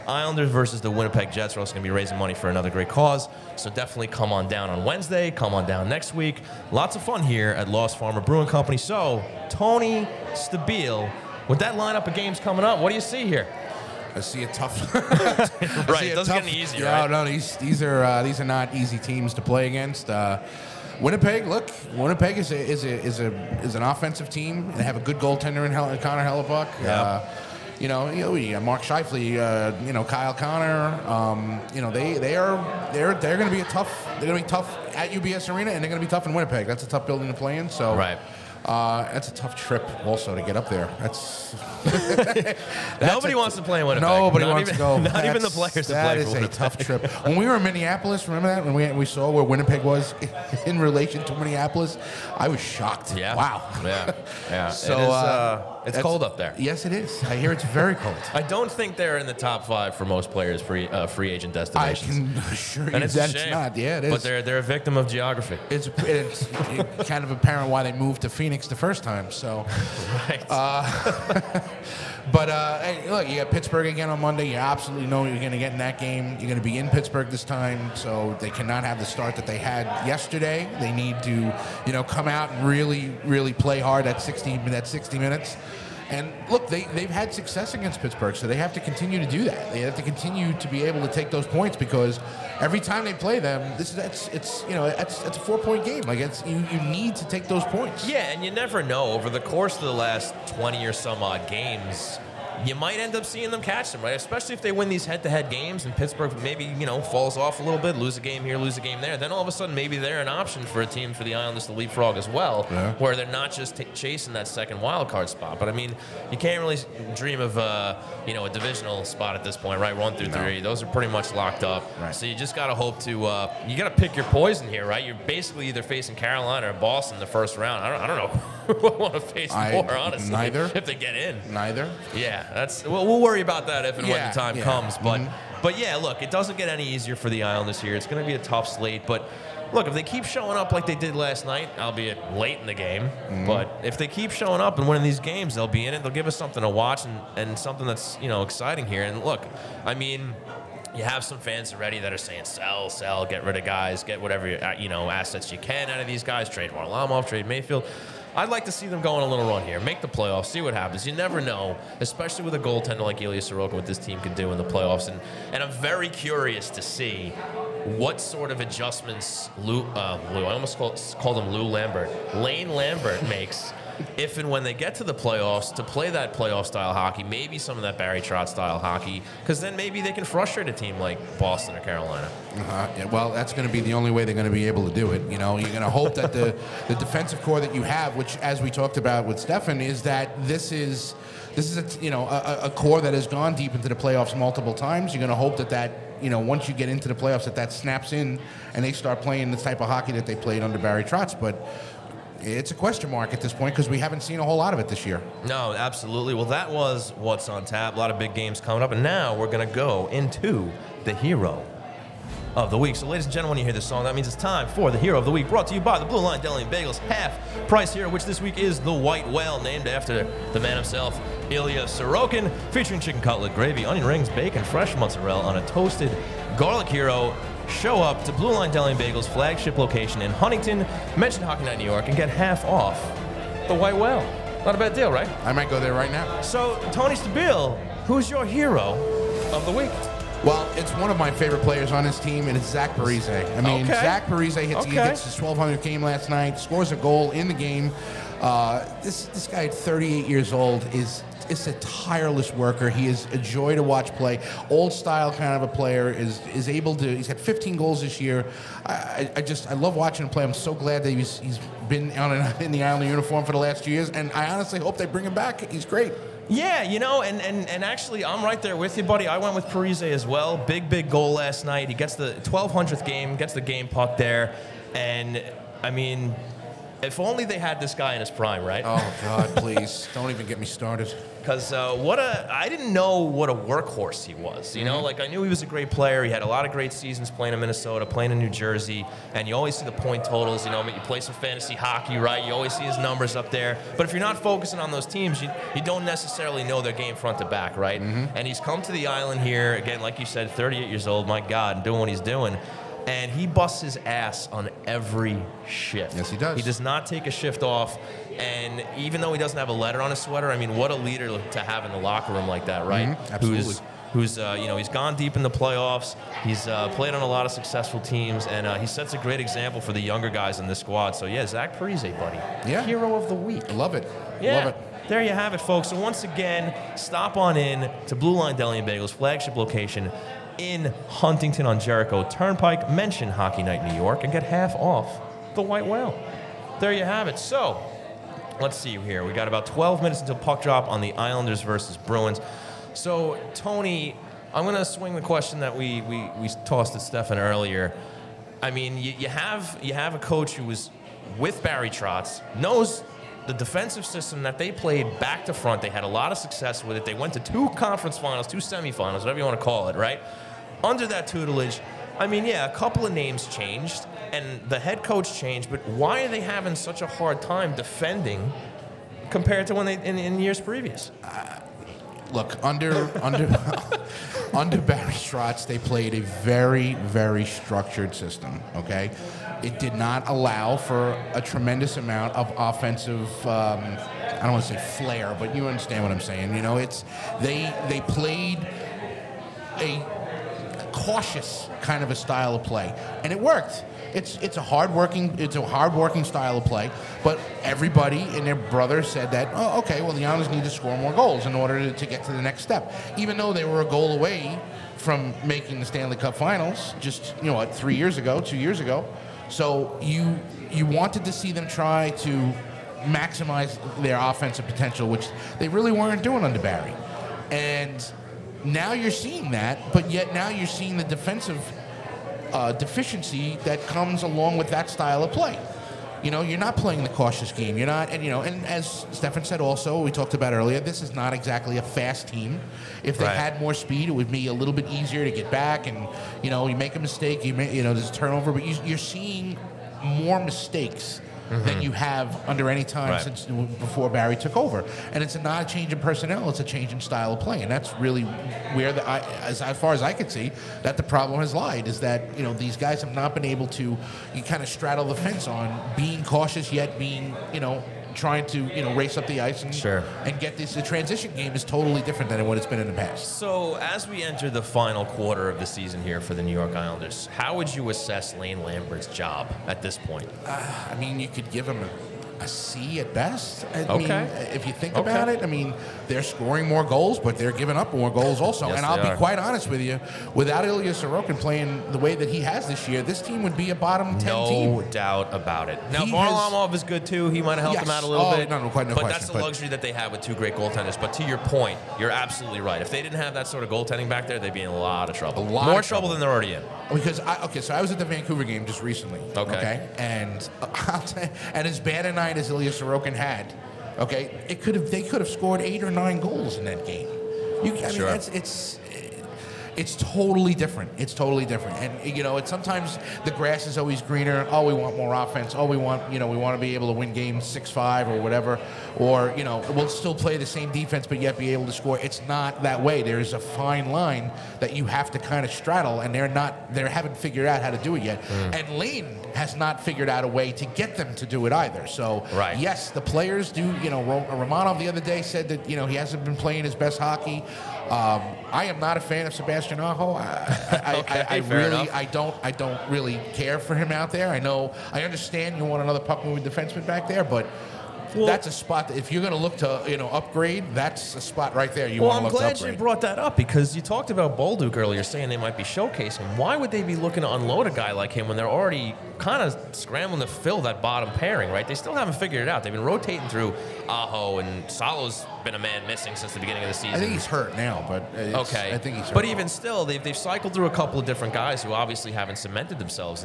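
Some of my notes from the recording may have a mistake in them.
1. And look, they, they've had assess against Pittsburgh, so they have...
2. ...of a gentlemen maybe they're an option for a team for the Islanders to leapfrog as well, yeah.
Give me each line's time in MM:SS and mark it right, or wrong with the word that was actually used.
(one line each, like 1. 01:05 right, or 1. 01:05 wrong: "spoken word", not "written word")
1. 01:26 wrong: "success", not "assess"
2. 01:49 wrong: "sudden", not "gentlemen".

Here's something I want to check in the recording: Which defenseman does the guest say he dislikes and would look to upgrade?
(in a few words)
Sebastian Aho.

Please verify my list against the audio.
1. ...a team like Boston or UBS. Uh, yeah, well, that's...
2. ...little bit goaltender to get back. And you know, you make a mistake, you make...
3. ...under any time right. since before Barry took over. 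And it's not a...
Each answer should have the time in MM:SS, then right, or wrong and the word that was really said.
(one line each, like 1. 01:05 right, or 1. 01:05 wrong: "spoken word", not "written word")
1. 03:00 wrong: "Carolina", not "UBS"
2. 07:14 wrong: "easier", not "goaltender"
3. 07:22 right.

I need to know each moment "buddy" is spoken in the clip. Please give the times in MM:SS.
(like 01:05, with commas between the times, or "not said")
04:29, 05:22.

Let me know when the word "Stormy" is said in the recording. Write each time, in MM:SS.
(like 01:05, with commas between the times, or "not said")
not said.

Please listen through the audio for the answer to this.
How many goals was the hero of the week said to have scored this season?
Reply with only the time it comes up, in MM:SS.
04:17.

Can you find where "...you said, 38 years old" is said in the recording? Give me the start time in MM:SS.
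05:00.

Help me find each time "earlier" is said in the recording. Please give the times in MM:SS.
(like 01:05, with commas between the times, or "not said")
05:47, 07:10, 09:14.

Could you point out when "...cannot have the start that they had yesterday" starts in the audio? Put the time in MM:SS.
01:18.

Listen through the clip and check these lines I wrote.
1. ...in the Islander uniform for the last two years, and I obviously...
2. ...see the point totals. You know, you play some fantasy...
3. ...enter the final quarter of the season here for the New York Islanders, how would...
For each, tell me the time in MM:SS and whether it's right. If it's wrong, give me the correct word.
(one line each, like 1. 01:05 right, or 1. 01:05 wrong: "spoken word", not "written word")
1. 04:22 wrong: "honestly", not "obviously"
2. 04:49 right
3. 07:44 right.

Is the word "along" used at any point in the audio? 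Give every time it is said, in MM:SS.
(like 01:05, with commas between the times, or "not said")
07:04.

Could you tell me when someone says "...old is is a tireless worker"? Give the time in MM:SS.
04:10.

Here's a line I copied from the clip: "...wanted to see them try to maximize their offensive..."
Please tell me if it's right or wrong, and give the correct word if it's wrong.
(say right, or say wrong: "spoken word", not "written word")
right.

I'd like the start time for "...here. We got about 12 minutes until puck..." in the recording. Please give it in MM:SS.
05:38.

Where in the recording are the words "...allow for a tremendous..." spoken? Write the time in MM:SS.
06:20.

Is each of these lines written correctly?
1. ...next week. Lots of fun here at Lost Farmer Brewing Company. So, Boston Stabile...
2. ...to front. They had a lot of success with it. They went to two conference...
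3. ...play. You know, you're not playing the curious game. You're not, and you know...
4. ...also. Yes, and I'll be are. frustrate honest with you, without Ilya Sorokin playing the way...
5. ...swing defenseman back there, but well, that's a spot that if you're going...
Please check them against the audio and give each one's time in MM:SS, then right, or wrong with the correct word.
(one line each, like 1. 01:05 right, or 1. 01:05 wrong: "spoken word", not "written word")
1. 00:05 wrong: "Tony", not "Boston"
2. 05:55 right
3. 07:05 wrong: "cautious", not "curious"
4. 07:58 wrong: "quite", not "frustrate"
5. 09:06 wrong: "moving", not "swing".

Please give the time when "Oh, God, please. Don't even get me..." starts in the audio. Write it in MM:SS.
04:38.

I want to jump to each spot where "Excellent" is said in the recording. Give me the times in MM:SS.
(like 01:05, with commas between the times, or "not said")
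not said.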